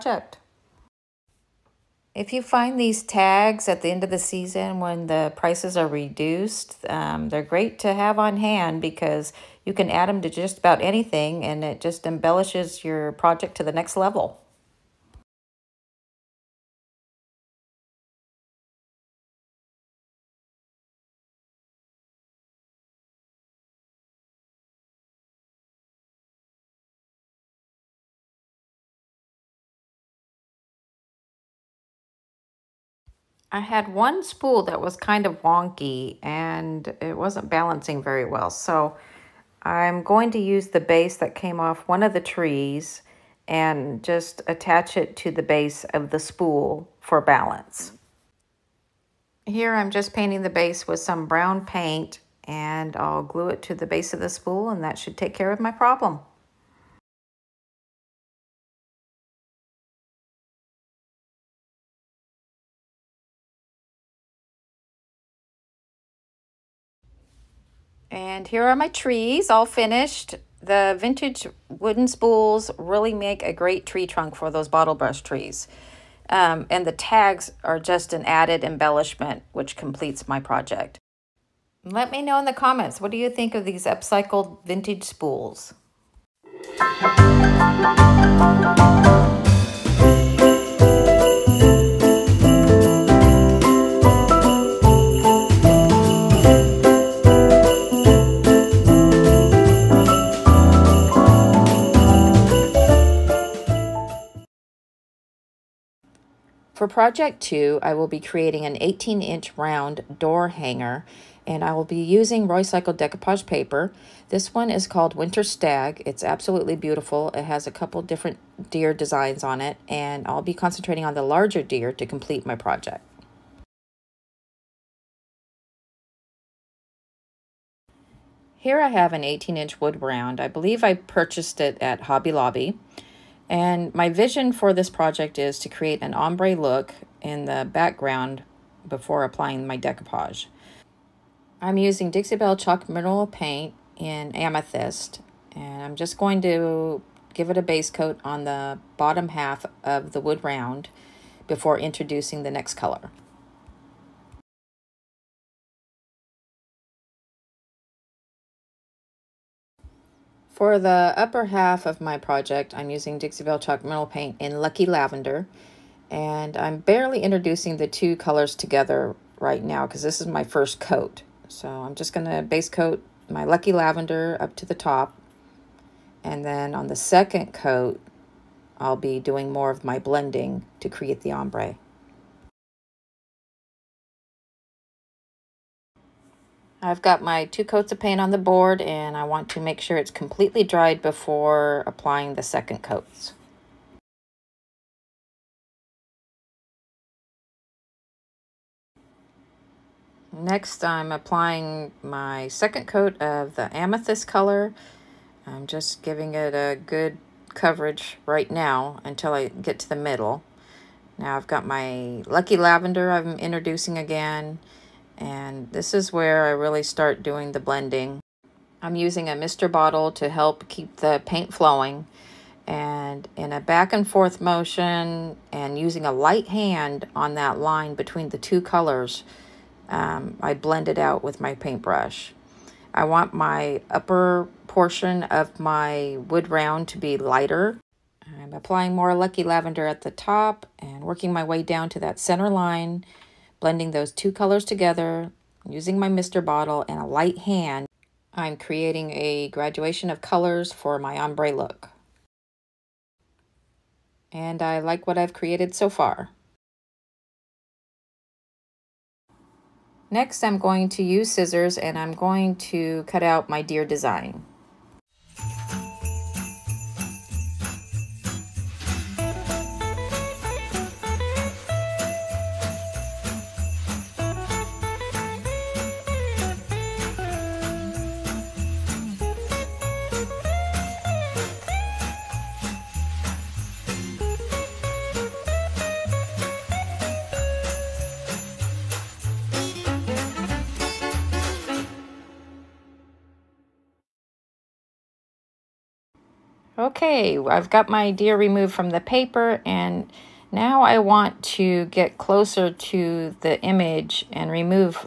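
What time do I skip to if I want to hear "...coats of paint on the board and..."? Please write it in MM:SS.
03:07.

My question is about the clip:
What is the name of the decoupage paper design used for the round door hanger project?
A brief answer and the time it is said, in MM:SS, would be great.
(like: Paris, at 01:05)
Winter Stag, at 01:55.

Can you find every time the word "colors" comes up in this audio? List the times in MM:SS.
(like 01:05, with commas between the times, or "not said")
02:32, 02:48, 03:24, 03:48, 04:04, 04:10.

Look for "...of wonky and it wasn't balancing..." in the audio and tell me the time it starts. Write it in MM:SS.
00:35.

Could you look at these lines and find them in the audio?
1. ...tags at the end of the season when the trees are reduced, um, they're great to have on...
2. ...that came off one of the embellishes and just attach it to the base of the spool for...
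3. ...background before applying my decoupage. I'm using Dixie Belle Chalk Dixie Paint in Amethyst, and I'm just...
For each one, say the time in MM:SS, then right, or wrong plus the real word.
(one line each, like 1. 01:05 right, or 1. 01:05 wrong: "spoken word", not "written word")
1. 00:03 wrong: "prices", not "trees"
2. 00:41 wrong: "trees", not "embellishes"
3. 02:17 wrong: "Mineral", not "Dixie".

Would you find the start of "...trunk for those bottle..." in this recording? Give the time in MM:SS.
01:14.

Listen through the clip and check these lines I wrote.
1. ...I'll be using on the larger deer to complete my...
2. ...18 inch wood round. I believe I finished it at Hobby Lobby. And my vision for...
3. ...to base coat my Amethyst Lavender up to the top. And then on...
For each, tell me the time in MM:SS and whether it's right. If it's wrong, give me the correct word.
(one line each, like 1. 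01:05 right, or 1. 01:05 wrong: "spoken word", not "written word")
1. 02:00 wrong: "concentrating", not "using"
2. 02:09 wrong: "purchased", not "finished"
3. 02:52 wrong: "Lucky", not "Amethyst".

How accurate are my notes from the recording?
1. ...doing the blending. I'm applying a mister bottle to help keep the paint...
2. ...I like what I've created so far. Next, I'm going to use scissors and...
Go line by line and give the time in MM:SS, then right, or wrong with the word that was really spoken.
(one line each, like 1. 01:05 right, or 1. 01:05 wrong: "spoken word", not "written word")
1. 03:37 wrong: "using", not "applying"
2. 04:14 right.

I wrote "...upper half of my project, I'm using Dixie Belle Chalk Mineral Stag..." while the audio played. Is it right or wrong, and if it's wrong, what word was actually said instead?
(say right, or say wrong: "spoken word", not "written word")
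wrong: "Paint", not "Stag".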